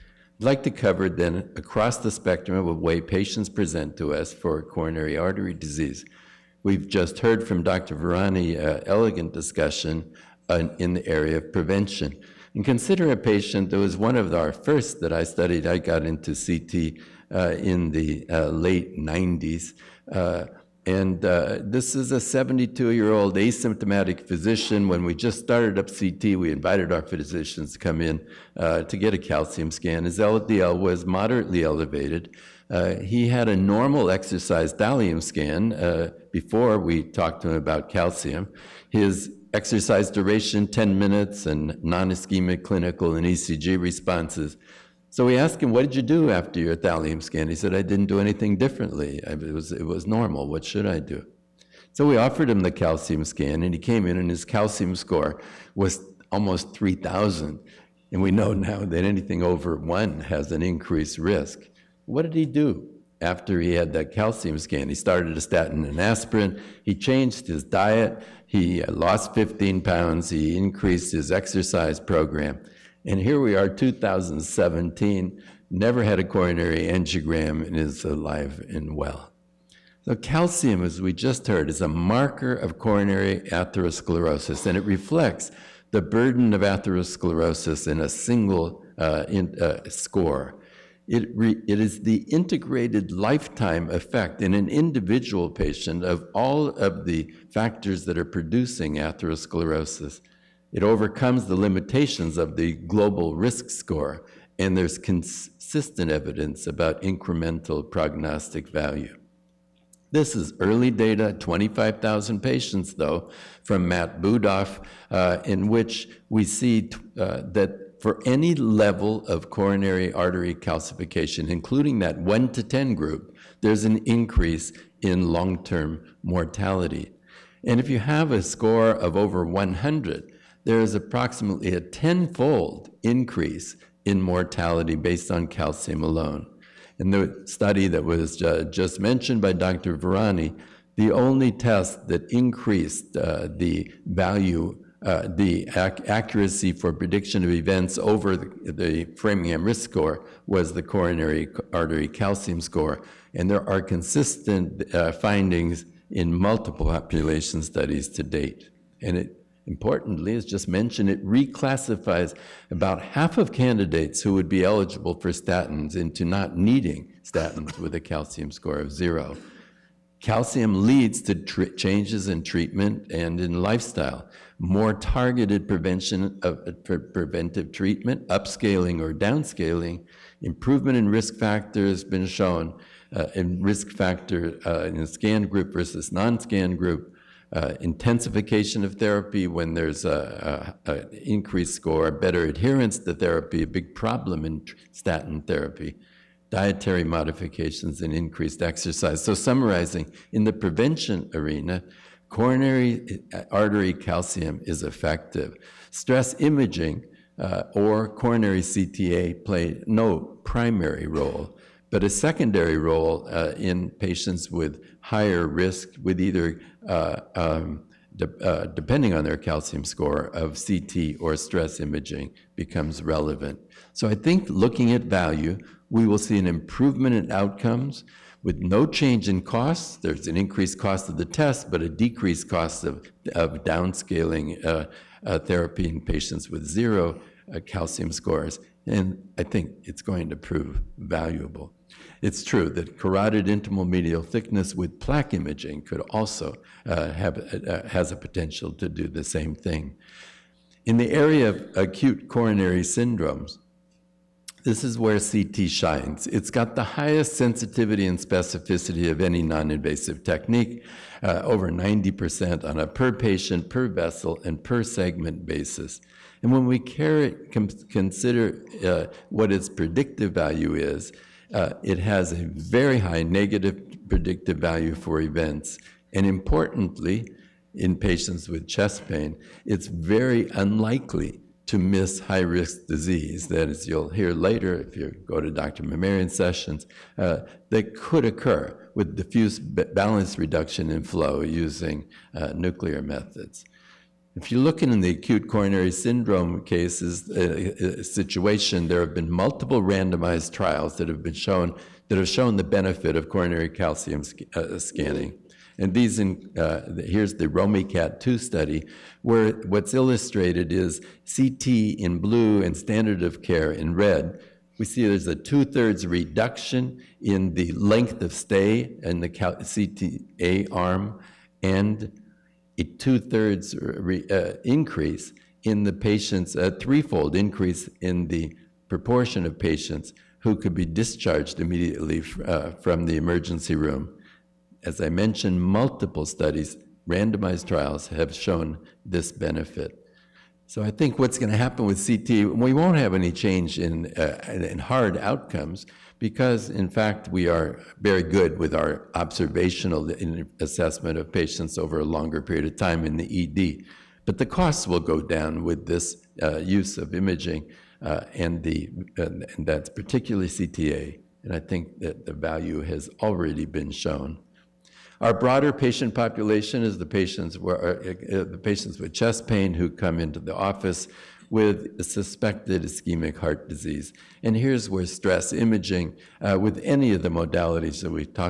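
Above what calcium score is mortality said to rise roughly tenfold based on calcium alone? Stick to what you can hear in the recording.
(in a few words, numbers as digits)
100.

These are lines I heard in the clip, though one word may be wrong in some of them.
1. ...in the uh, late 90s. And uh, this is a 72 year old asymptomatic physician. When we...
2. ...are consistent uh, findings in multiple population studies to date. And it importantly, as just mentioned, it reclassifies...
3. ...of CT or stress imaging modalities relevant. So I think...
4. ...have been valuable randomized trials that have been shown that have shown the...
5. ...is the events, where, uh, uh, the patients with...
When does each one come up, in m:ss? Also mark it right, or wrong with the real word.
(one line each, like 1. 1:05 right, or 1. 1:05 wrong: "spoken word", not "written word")
1. 0:17 right
2. 2:33 right
3. 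3:40 wrong: "becomes", not "modalities"
4. 4:58 wrong: "multiple", not "valuable"
5. 6:06 wrong: "patients", not "events".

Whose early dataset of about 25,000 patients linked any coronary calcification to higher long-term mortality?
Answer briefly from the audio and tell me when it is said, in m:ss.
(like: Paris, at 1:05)
Matt Budoff, at 1:53.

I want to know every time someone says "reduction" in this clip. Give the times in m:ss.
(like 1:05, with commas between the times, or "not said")
4:50, 5:16.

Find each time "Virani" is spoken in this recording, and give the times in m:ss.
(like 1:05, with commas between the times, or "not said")
0:07, 2:19.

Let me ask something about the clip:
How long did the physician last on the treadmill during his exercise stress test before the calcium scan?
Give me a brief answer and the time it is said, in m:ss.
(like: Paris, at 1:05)
10 minutes, at 0:40.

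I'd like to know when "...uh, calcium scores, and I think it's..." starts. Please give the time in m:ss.
3:57.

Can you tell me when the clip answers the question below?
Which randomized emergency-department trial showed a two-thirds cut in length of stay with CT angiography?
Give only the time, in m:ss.
5:07.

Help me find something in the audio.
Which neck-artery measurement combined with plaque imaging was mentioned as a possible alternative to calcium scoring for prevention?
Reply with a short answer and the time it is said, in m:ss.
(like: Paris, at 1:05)
carotid intimal medial thickness, at 4:02.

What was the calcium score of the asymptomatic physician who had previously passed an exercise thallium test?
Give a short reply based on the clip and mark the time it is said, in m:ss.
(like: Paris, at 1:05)
almost 3,000, at 0:56.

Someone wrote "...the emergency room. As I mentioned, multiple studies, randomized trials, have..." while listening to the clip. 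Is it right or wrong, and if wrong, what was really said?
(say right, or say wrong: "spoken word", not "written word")
right.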